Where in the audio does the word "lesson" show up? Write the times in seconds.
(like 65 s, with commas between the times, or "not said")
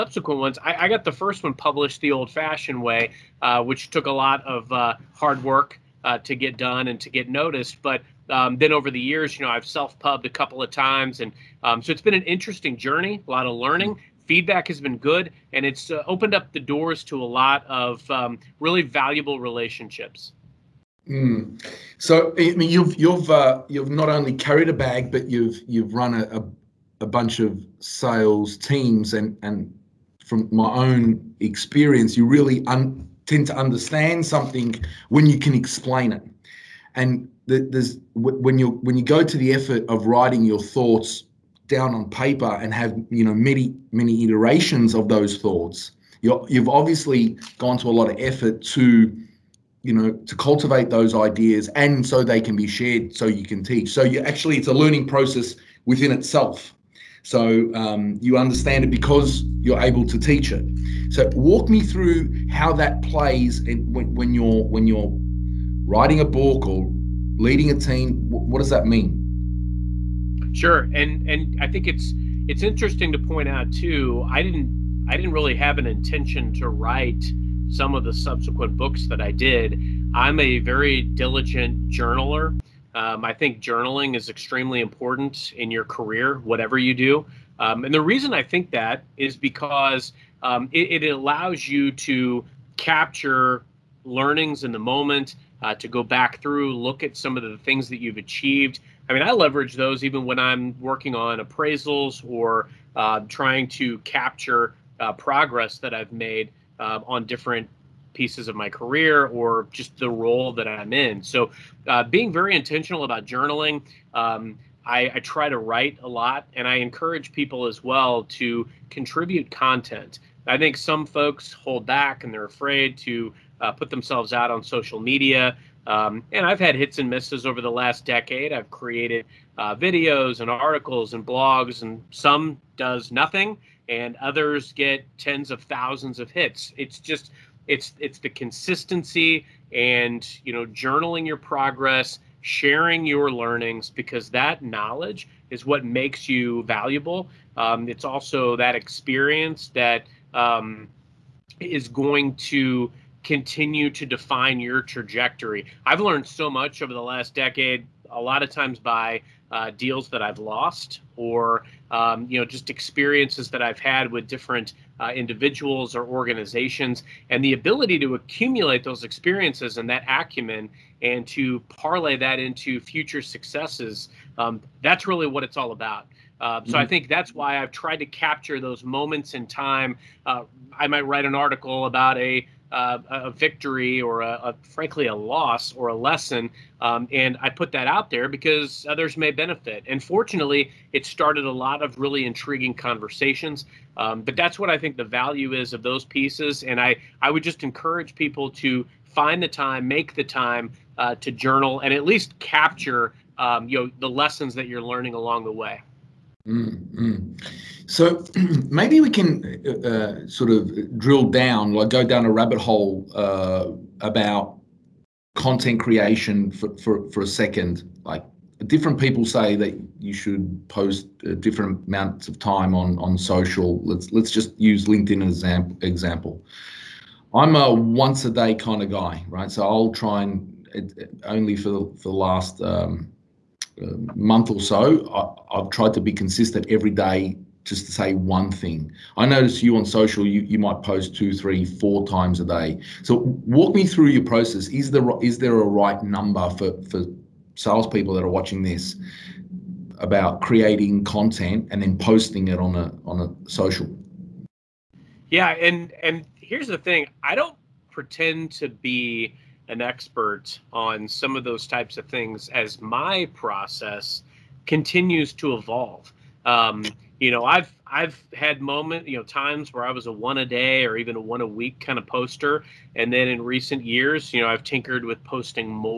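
185 s, 204 s.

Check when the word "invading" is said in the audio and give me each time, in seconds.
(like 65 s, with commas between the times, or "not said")
not said.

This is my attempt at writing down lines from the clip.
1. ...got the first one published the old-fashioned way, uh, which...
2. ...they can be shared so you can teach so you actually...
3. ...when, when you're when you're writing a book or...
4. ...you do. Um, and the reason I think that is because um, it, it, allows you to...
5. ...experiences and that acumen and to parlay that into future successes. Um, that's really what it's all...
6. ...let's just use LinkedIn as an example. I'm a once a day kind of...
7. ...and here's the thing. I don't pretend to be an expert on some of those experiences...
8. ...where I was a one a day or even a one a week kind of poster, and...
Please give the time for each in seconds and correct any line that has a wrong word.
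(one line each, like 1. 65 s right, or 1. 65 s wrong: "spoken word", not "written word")
1. 0 s right
2. 52 s right
3. 63 s right
4. 86 s right
5. 169 s right
6. 224 s right
7. 256 s wrong: "types", not "experiences"
8. 269 s right.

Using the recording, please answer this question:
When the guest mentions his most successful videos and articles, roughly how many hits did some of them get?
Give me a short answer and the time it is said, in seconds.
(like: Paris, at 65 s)
Tens of thousands, at 135 s.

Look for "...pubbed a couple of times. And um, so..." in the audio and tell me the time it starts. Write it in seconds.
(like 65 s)
9 s.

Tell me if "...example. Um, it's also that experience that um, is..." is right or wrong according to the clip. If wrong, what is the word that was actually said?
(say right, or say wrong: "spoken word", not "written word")
wrong: "valuable", not "example".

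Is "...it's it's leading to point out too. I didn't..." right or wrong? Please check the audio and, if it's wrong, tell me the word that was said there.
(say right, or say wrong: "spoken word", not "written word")
wrong: "interesting", not "leading".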